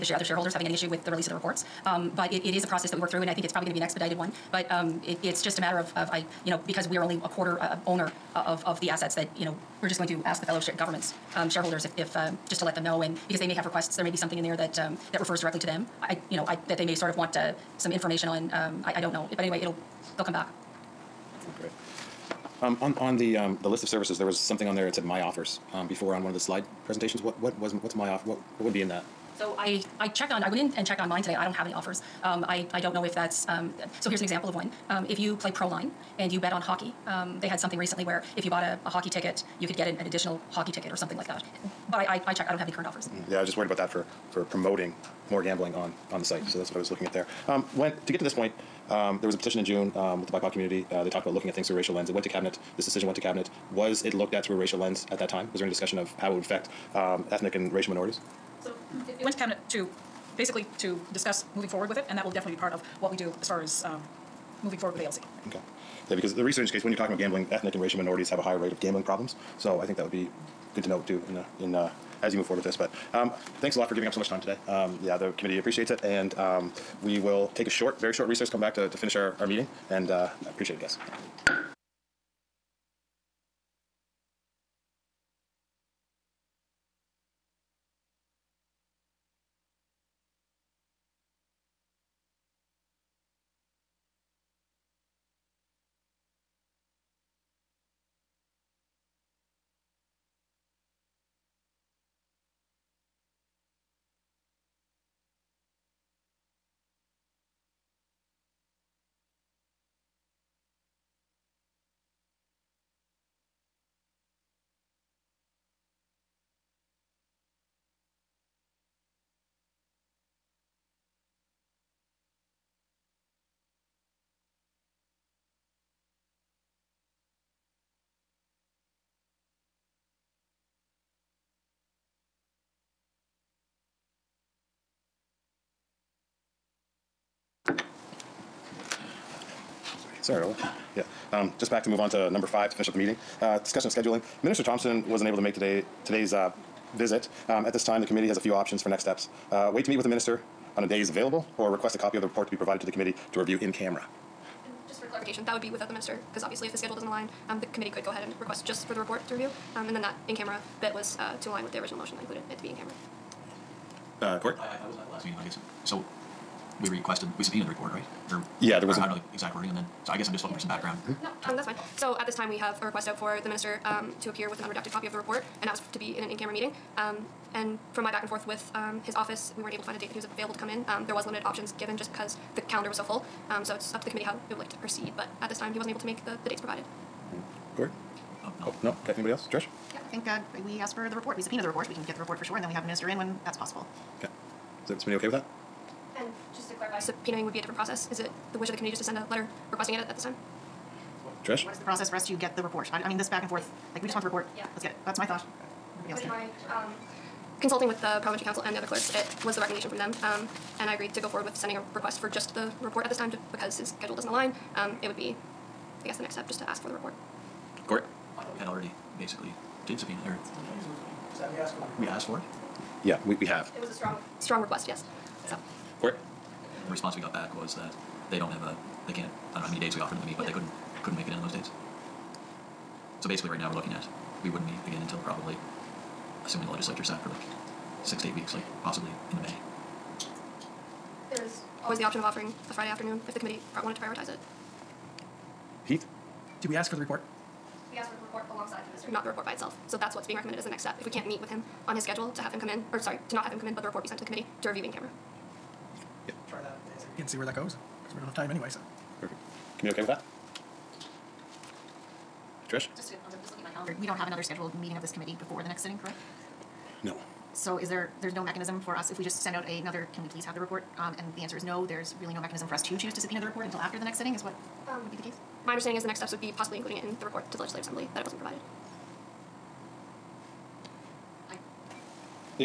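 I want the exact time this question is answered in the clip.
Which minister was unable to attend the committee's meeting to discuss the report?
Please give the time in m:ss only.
2:24.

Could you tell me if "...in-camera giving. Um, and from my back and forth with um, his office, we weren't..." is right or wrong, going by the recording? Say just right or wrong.
wrong.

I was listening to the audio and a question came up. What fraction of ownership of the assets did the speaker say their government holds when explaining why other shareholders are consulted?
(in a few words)
a quarter.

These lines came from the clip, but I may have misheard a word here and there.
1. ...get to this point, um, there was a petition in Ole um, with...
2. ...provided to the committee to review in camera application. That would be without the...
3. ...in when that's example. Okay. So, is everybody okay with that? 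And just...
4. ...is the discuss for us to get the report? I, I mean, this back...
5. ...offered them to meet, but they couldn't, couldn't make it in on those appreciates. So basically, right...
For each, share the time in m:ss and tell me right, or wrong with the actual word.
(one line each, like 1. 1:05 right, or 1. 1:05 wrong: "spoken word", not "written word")
1. 0:48 wrong: "June", not "Ole"
2. 2:32 right
3. 3:13 wrong: "possible", not "example"
4. 3:21 wrong: "process", not "discuss"
5. 3:49 wrong: "dates", not "appreciates".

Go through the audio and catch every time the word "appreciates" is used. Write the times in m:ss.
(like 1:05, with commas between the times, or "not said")
1:15, 1:20.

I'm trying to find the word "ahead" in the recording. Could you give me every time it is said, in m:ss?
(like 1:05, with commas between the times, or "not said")
2:38.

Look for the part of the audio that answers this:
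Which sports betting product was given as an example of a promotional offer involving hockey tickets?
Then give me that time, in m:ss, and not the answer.
0:35.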